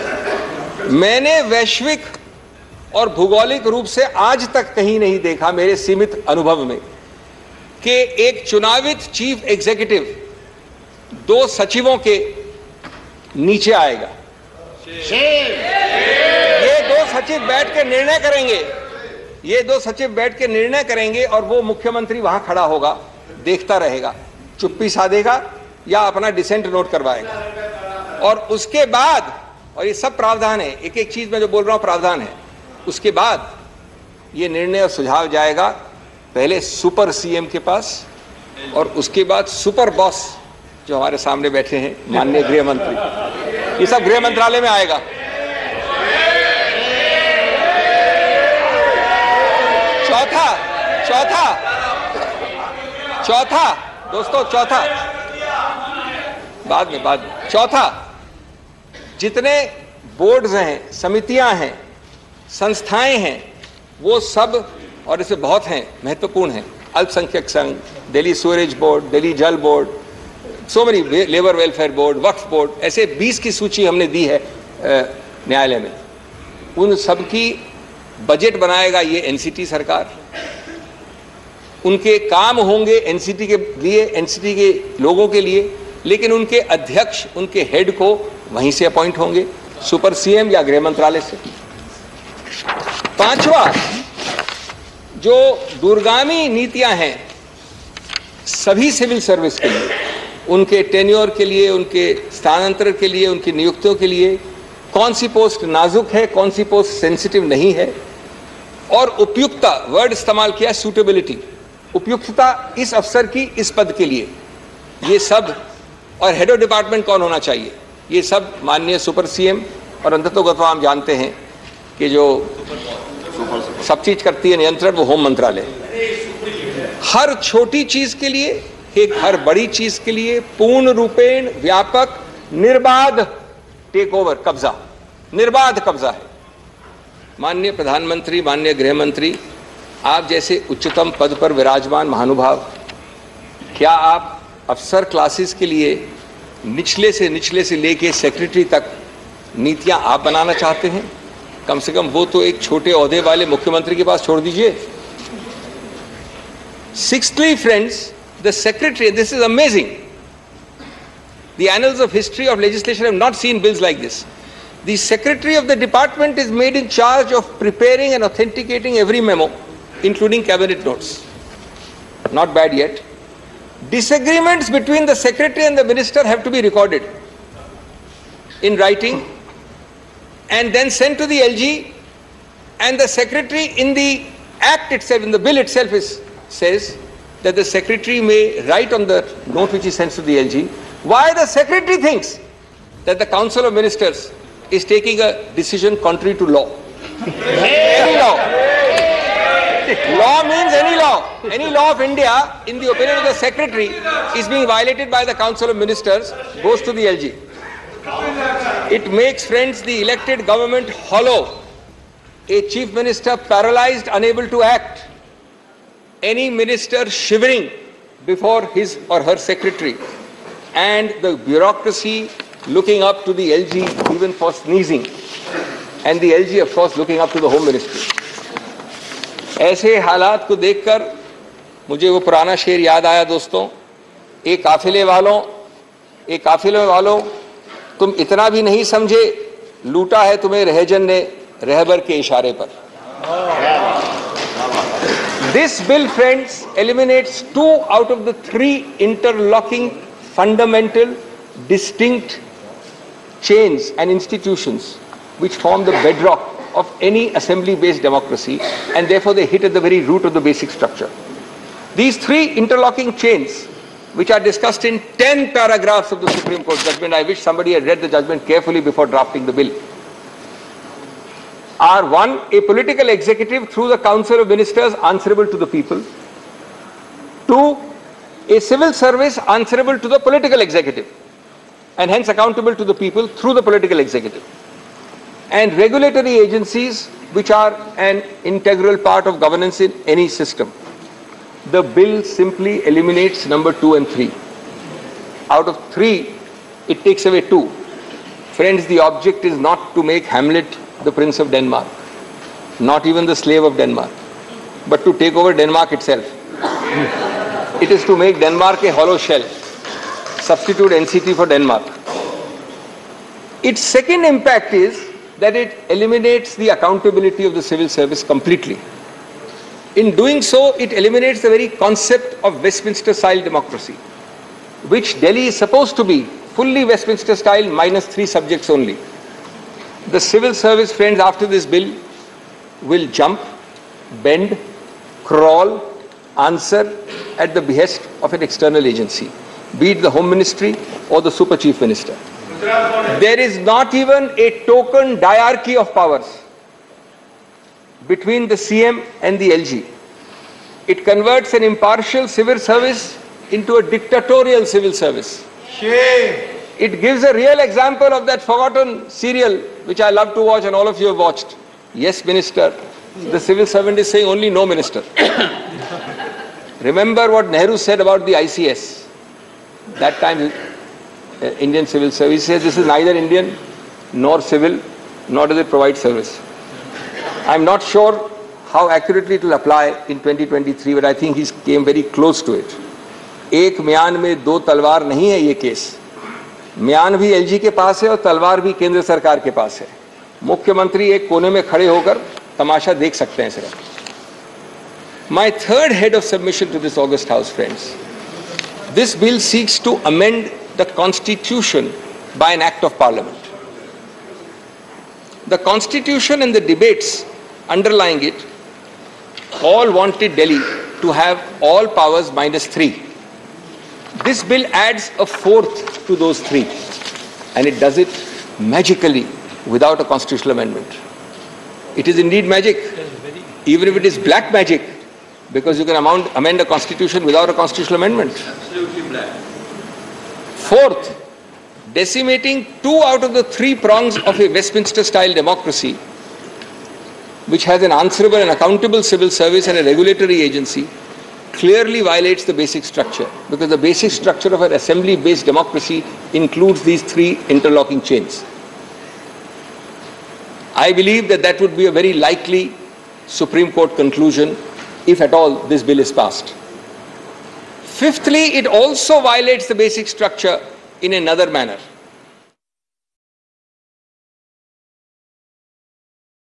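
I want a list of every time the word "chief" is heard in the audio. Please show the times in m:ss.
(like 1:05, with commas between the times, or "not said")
3:32, 5:41.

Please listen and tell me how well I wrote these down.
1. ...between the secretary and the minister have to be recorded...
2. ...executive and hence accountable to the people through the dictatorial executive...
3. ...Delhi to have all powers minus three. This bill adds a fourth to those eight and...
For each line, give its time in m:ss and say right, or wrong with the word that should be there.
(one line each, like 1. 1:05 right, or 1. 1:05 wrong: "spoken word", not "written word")
1. 2:54 right
2. 4:40 wrong: "political", not "dictatorial"
3. 6:50 wrong: "three", not "eight".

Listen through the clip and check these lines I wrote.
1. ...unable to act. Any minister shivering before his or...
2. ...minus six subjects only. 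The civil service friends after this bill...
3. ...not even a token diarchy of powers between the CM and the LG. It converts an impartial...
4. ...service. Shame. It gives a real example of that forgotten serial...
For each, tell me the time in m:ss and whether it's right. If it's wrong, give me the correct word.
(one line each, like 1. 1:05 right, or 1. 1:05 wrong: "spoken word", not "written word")
1. 3:34 right
2. 5:27 wrong: "three", not "six"
3. 5:43 right
4. 5:54 right.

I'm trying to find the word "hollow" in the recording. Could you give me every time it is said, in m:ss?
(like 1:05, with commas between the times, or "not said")
3:30, 5:08.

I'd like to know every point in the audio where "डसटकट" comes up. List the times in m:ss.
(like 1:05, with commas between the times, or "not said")
4:11.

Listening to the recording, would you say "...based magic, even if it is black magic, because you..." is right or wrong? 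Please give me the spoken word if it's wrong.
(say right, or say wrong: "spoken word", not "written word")
wrong: "indeed", not "based".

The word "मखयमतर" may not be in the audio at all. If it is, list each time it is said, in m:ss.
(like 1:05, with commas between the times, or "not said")
0:21, 2:33, 6:30.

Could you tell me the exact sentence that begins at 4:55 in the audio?
Out of three, it takes away two.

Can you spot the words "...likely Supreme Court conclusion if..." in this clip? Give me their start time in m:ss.
7:32.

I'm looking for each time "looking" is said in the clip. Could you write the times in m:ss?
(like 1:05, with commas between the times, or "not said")
3:42, 3:46.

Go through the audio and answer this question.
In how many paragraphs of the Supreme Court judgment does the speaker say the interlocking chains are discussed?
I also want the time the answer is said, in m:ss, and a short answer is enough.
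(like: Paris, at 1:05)
10, at 4:25.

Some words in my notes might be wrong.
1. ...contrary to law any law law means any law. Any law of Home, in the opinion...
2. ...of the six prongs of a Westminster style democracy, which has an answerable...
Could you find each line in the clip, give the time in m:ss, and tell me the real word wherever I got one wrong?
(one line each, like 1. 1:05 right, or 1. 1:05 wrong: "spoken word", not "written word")
1. 3:16 wrong: "India", not "Home"
2. 7:13 wrong: "three", not "six".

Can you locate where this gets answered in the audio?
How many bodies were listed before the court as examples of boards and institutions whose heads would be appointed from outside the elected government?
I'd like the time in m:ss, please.
1:13.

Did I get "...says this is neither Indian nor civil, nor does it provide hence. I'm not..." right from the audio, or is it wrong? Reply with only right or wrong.
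wrong.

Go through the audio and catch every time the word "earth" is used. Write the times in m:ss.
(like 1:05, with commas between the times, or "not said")
not said.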